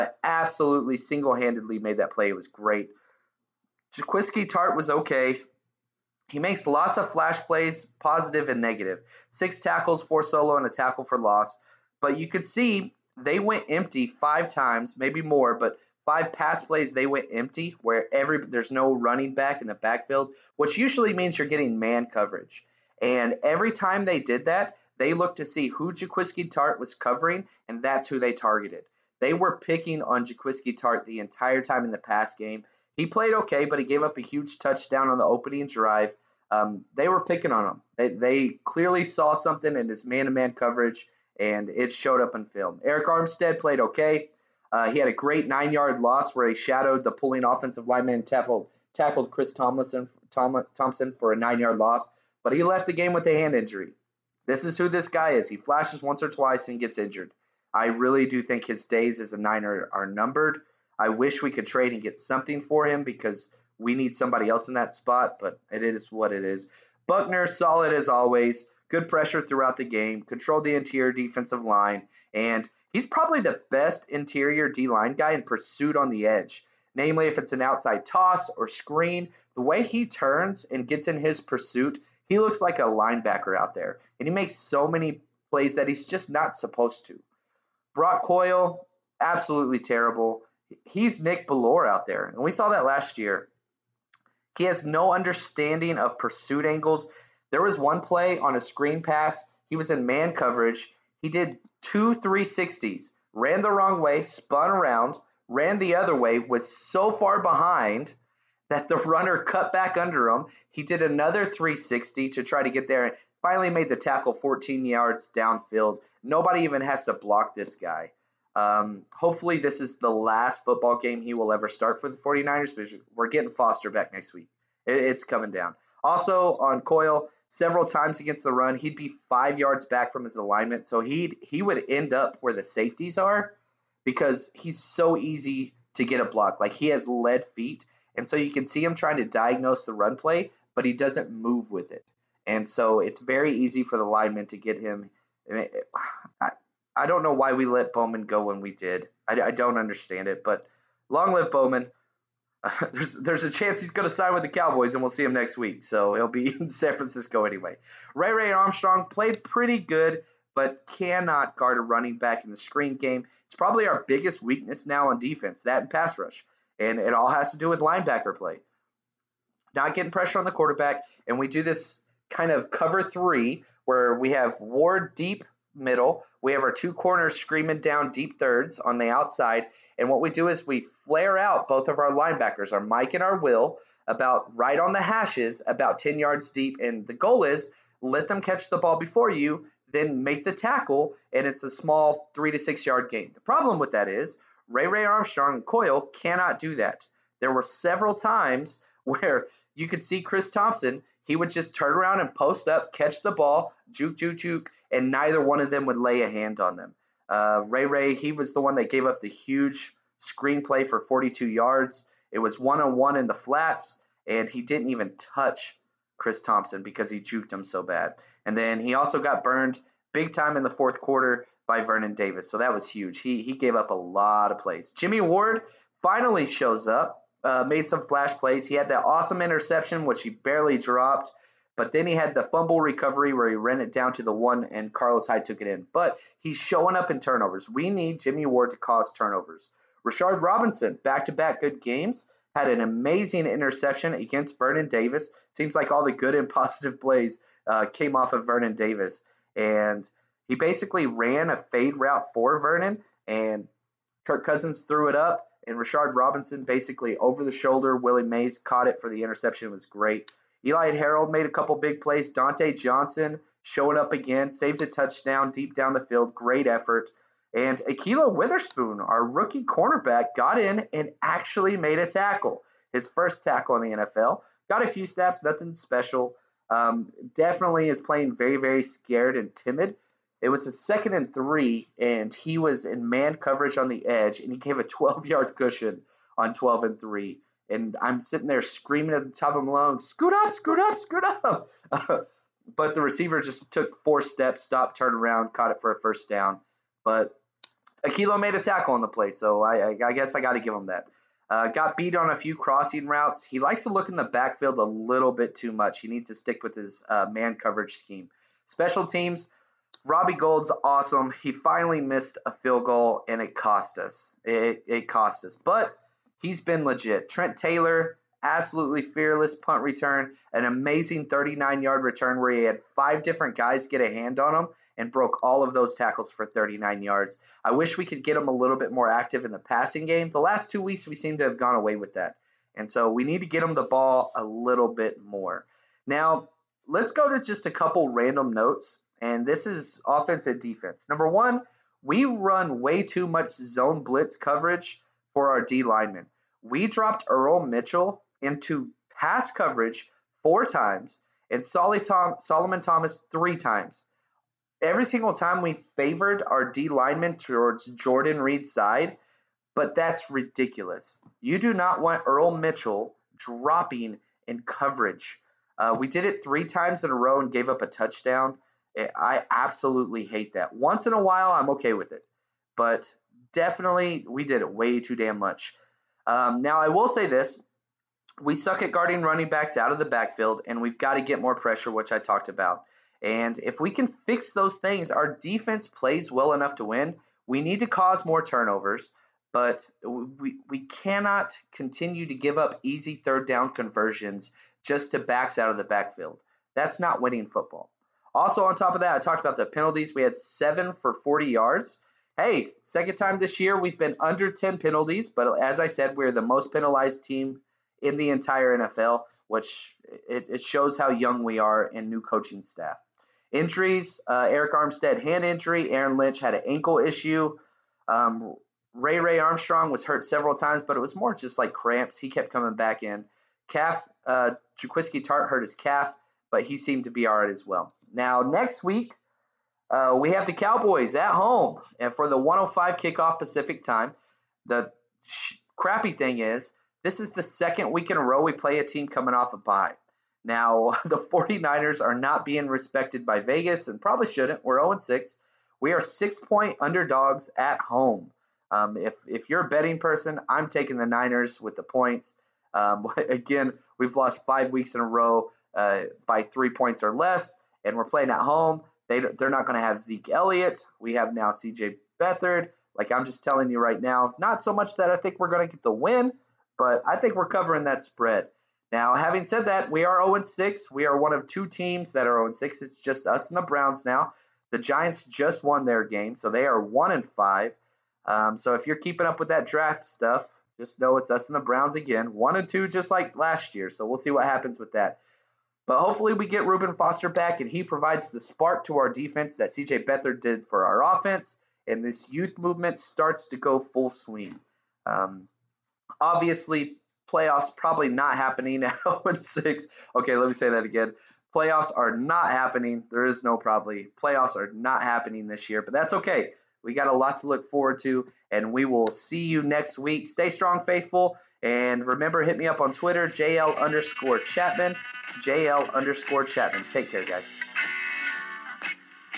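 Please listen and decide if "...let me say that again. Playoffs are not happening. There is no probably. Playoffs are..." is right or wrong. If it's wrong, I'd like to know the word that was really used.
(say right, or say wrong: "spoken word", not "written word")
right.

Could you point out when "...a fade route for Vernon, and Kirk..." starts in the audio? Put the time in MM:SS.
04:11.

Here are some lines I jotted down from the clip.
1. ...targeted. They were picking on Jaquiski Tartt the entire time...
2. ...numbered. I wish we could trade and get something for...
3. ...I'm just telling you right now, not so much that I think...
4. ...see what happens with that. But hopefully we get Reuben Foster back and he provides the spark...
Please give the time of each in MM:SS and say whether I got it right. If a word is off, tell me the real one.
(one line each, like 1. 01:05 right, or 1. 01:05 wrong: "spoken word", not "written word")
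1. 00:28 right
2. 01:00 right
3. 07:43 right
4. 08:04 right.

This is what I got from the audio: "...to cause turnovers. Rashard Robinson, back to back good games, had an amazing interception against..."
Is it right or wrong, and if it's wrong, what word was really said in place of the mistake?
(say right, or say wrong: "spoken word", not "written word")
right.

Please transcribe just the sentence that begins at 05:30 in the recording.
The last two weeks, we seem to have gone away with that.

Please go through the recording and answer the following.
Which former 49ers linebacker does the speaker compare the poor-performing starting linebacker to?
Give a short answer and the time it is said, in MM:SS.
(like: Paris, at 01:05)
Nick Bellore, at 01:31.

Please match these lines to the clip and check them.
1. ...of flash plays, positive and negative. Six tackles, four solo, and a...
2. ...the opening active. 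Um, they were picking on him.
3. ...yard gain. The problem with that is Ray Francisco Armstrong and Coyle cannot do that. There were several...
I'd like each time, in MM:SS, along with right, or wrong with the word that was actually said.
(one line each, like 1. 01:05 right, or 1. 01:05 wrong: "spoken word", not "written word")
1. 00:06 right
2. 00:35 wrong: "drive", not "active"
3. 03:12 wrong: "Ray", not "Francisco".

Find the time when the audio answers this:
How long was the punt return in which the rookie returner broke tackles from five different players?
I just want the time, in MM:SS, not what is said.
05:21.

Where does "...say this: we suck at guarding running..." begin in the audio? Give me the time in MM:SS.
06:17.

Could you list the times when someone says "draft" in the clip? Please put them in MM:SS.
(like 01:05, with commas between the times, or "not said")
07:59.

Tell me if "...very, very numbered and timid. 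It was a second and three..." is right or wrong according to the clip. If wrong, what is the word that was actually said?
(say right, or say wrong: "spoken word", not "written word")
wrong: "scared", not "numbered".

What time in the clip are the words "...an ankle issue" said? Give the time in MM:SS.
06:56.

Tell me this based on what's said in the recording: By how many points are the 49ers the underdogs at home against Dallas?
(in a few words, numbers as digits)
6.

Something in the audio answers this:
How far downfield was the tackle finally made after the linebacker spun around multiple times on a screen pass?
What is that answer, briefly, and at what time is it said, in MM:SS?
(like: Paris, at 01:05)
14 yards, at 01:54.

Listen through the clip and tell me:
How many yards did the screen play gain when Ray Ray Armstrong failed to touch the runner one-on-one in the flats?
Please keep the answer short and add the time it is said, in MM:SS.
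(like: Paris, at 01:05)
42, at 03:31.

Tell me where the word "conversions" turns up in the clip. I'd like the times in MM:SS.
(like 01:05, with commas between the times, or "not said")
06:33.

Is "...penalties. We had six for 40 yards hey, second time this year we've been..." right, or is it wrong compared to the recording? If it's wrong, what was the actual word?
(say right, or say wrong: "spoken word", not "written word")
wrong: "seven", not "six".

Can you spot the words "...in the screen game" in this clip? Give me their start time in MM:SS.
02:42.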